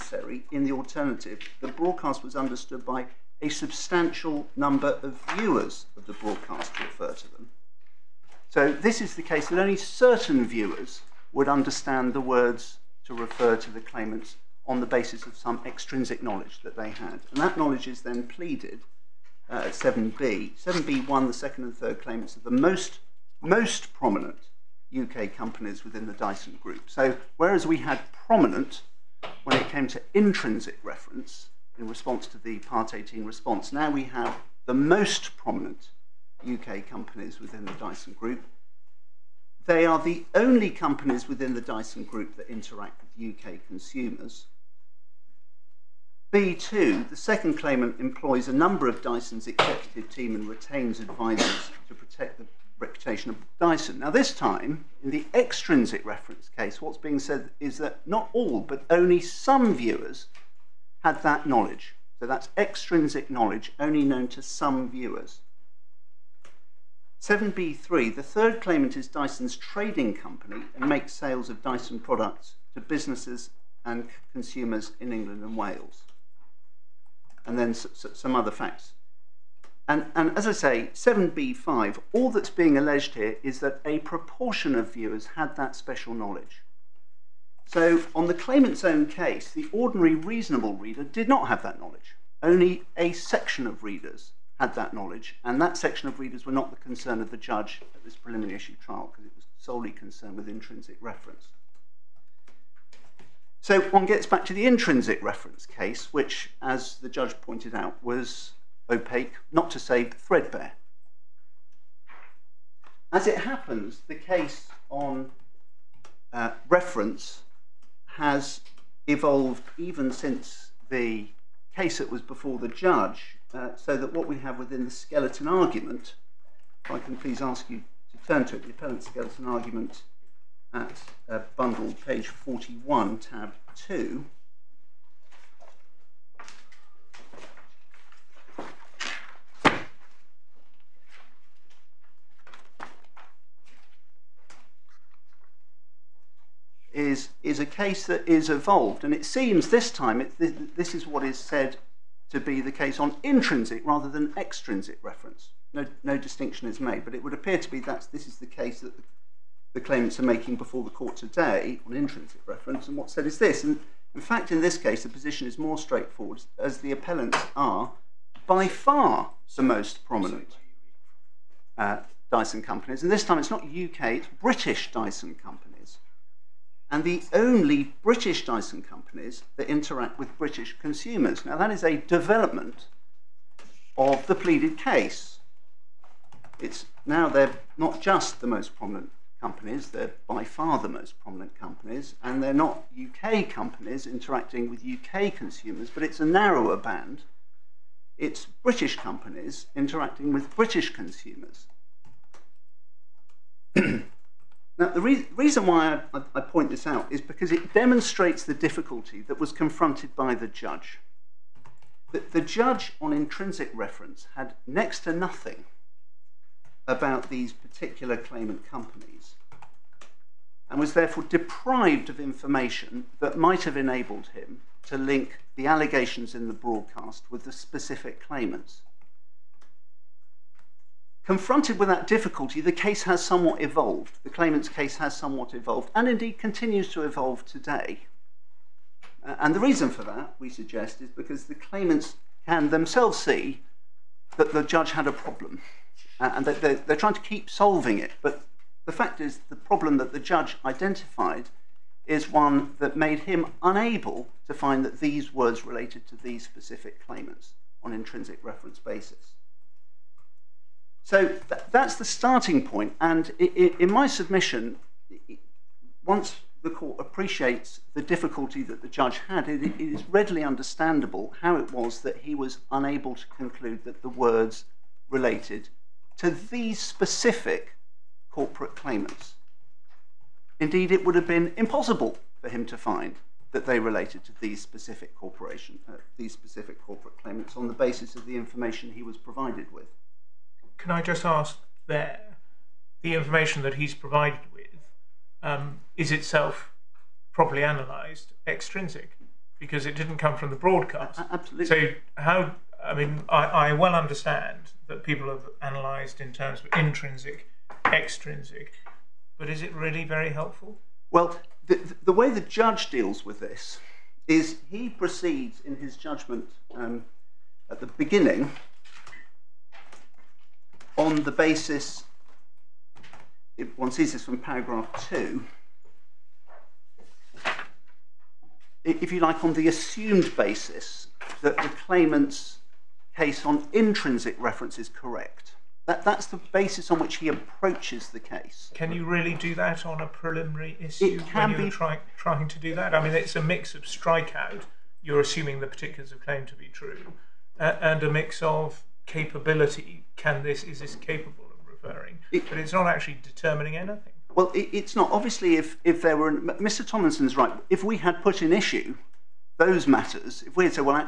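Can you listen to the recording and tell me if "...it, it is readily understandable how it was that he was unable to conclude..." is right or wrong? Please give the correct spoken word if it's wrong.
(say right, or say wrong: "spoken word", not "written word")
right.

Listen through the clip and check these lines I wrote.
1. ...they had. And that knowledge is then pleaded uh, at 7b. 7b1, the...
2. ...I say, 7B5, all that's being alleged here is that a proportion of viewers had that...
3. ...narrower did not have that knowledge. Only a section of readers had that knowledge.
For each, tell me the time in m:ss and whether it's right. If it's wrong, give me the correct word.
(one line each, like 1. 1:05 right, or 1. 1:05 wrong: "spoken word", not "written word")
1. 0:16 right
2. 1:20 right
3. 1:30 wrong: "reader", not "narrower".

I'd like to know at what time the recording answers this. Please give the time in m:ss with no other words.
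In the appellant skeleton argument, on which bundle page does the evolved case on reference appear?
2:11.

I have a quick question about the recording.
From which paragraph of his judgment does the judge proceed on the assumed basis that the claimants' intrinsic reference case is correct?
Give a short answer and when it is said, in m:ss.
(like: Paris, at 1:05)
2, at 5:24.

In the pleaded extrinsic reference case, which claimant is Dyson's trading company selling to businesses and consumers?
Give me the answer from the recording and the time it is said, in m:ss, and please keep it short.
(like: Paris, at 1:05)
The third claimant, at 1:07.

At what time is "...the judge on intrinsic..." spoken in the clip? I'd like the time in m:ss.
3:32.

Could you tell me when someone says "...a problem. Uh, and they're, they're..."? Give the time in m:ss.
4:05.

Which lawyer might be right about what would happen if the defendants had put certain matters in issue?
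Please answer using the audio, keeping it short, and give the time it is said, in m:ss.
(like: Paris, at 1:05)
Mr. Tomlinson, at 5:56.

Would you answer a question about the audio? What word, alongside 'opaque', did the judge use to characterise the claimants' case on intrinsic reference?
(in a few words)
threadbare.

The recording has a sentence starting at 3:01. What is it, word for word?
Now, that is a development of the pleaded case.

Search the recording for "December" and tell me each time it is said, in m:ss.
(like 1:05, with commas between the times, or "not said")
not said.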